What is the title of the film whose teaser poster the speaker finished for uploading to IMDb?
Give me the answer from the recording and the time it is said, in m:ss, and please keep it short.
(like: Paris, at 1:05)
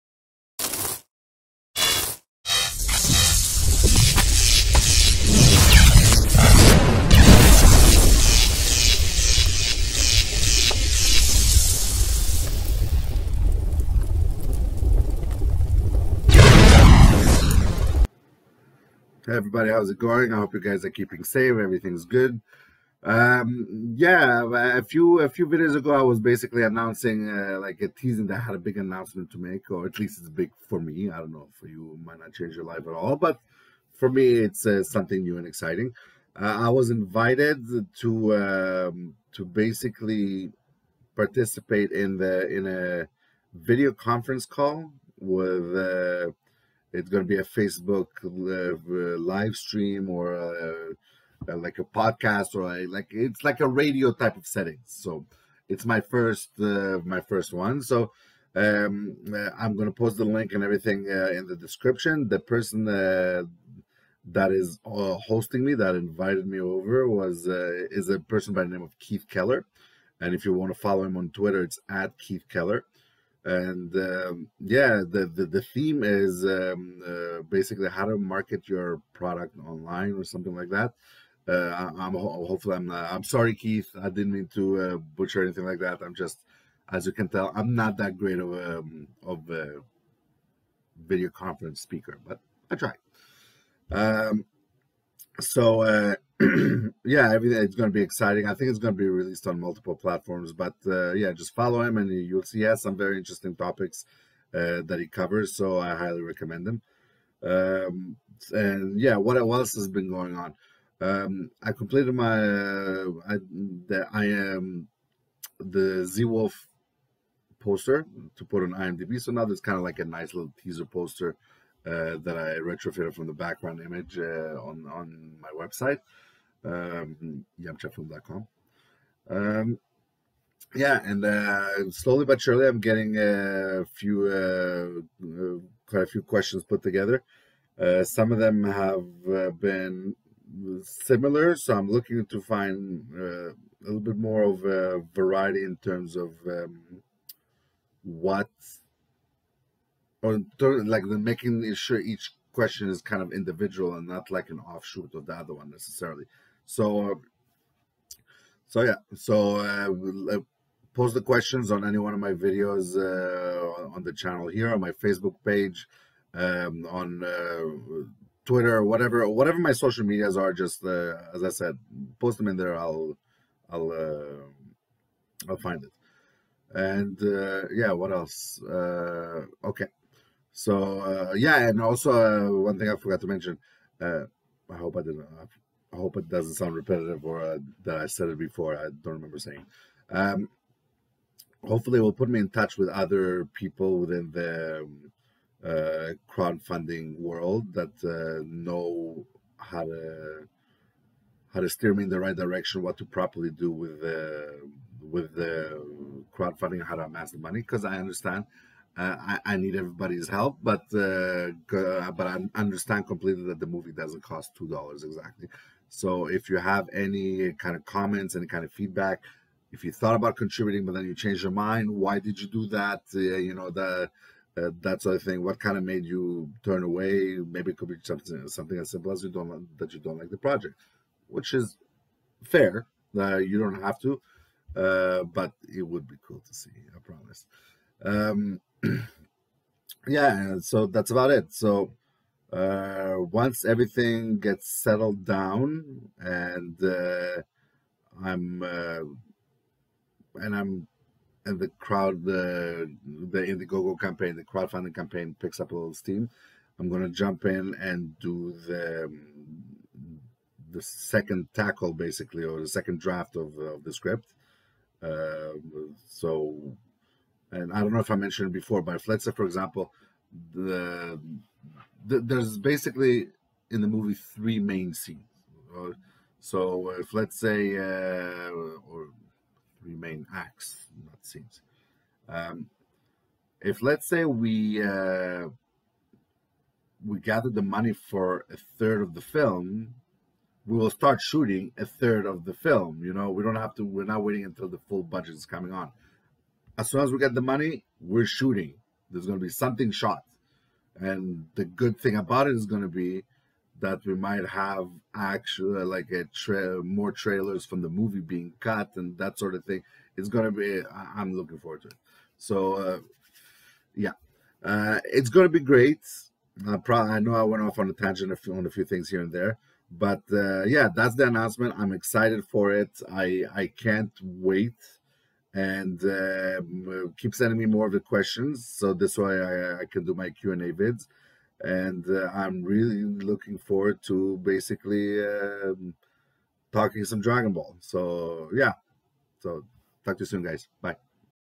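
I Am the Z Wolf, at 1:54.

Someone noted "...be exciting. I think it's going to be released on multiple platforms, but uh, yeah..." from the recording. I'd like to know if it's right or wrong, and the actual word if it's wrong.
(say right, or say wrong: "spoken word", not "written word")
right.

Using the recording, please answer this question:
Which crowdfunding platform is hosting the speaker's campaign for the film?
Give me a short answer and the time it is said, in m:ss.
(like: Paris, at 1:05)
Indiegogo, at 4:13.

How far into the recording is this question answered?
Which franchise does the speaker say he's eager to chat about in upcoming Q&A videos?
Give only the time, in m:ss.
5:37.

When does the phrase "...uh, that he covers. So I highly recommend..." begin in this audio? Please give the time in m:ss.
1:44.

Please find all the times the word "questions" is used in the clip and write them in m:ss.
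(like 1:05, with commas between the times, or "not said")
2:16, 2:32, 2:41, 5:27.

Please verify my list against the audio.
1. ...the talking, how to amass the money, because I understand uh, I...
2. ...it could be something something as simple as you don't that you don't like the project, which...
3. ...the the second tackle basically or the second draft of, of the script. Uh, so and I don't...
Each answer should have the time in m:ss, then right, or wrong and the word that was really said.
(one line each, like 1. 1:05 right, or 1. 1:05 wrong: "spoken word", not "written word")
1. 3:25 wrong: "crowdfunding", not "talking"
2. 3:47 right
3. 4:18 right.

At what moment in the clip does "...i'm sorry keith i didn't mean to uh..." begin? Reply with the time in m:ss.
1:23.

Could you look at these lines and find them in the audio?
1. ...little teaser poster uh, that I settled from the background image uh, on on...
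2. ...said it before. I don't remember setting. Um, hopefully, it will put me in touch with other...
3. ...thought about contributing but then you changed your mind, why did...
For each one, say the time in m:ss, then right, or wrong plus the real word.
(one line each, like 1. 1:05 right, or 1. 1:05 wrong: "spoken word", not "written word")
1. 2:00 wrong: "retrofitted", not "settled"
2. 3:08 wrong: "saying", not "setting"
3. 3:39 right.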